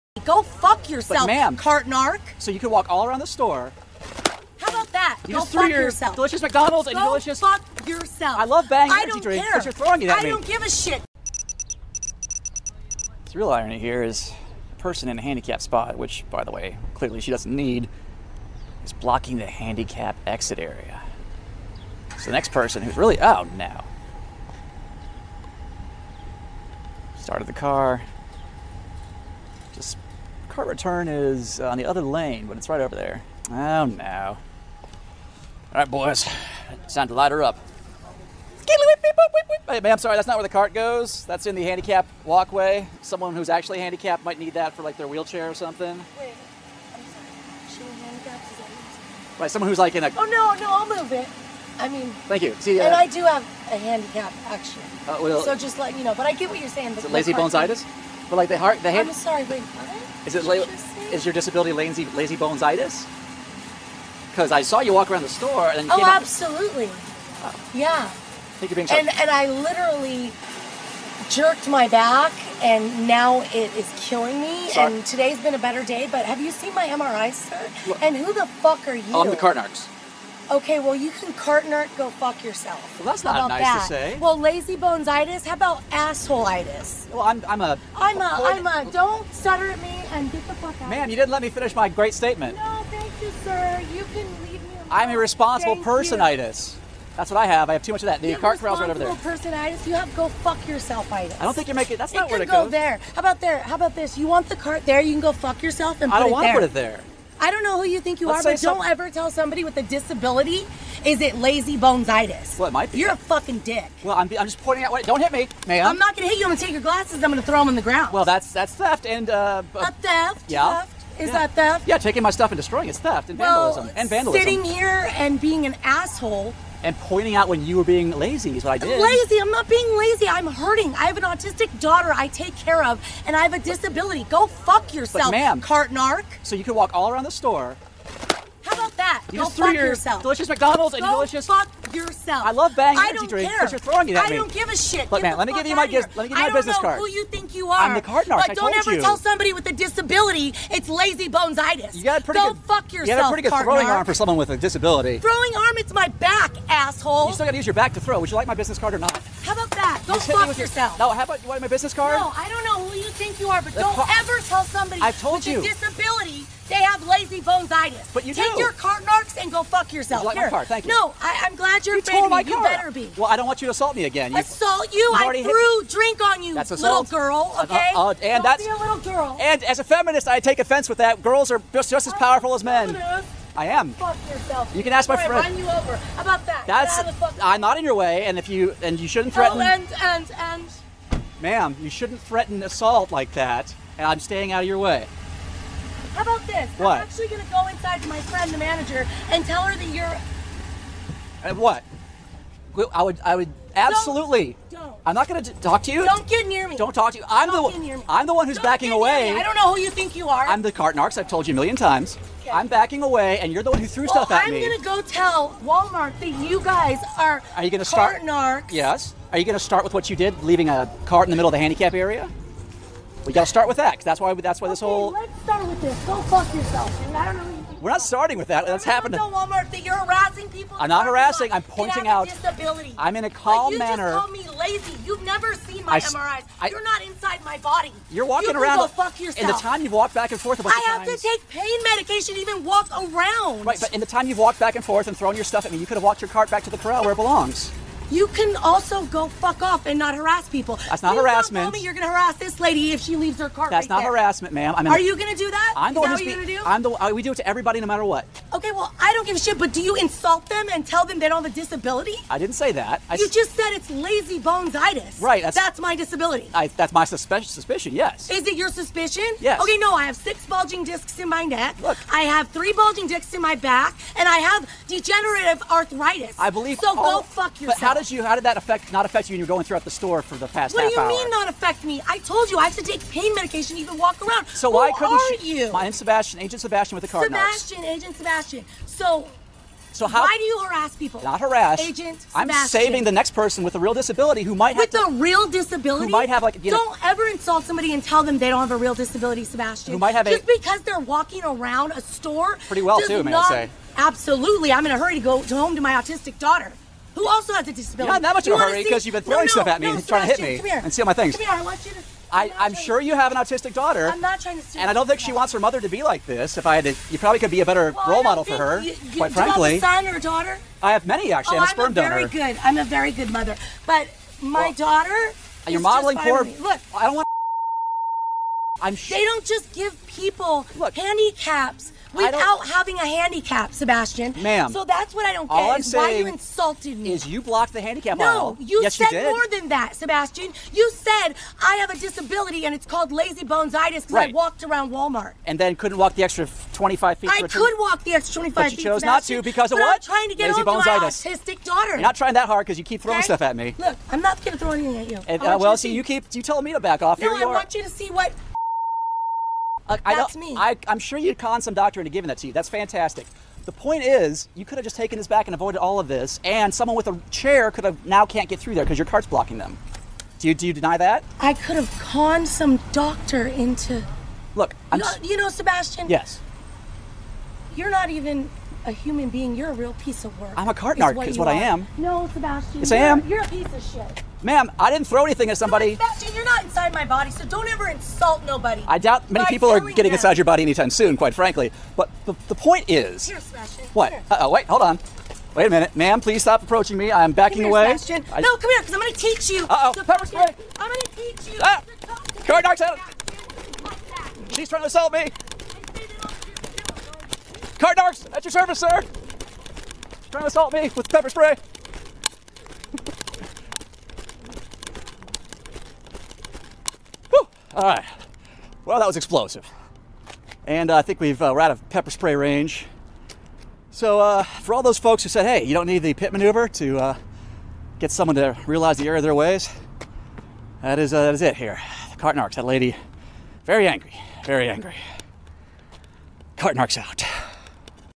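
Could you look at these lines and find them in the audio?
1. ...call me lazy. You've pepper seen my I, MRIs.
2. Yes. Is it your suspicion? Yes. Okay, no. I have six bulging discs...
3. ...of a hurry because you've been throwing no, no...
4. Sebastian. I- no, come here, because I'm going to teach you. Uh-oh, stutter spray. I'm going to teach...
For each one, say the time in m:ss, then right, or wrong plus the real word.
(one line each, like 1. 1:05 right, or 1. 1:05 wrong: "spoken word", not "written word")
1. 3:54 wrong: "never", not "pepper"
2. 4:27 right
3. 5:08 right
4. 6:37 wrong: "pepper", not "stutter".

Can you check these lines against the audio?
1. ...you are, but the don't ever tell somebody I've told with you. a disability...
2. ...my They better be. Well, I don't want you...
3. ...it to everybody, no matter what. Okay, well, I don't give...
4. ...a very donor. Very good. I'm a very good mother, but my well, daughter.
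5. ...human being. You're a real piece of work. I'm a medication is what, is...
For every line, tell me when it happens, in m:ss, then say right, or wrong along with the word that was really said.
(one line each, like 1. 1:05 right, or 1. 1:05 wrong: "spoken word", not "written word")
1. 2:43 right
2. 2:52 wrong: "You", not "They"
3. 4:17 right
4. 5:21 right
5. 6:18 wrong: "carton", not "medication".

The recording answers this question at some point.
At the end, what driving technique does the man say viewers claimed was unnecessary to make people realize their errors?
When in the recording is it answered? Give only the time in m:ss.
7:06.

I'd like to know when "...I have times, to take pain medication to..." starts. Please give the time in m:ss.
4:00.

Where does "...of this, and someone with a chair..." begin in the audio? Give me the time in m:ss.
6:05.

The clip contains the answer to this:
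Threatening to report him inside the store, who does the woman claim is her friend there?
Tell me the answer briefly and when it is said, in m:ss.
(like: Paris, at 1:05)
the manager, at 3:18.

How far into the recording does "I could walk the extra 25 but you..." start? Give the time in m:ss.
5:47.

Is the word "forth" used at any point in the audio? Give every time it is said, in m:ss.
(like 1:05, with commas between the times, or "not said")
4:00, 4:04.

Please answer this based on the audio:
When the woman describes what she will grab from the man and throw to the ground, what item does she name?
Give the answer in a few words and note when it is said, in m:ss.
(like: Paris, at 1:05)
glasses, at 1:56.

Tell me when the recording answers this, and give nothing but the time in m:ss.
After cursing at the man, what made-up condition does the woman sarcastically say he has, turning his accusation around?
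1:25.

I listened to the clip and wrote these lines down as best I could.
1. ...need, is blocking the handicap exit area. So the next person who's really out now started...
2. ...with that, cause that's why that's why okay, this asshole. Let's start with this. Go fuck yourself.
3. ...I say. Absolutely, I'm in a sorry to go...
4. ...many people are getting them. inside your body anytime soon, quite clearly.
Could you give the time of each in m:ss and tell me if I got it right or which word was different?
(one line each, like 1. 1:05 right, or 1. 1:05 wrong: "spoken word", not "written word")
1. 0:17 right
2. 3:43 wrong: "whole", not "asshole"
3. 5:03 wrong: "hurry", not "sorry"
4. 6:29 wrong: "frankly", not "clearly".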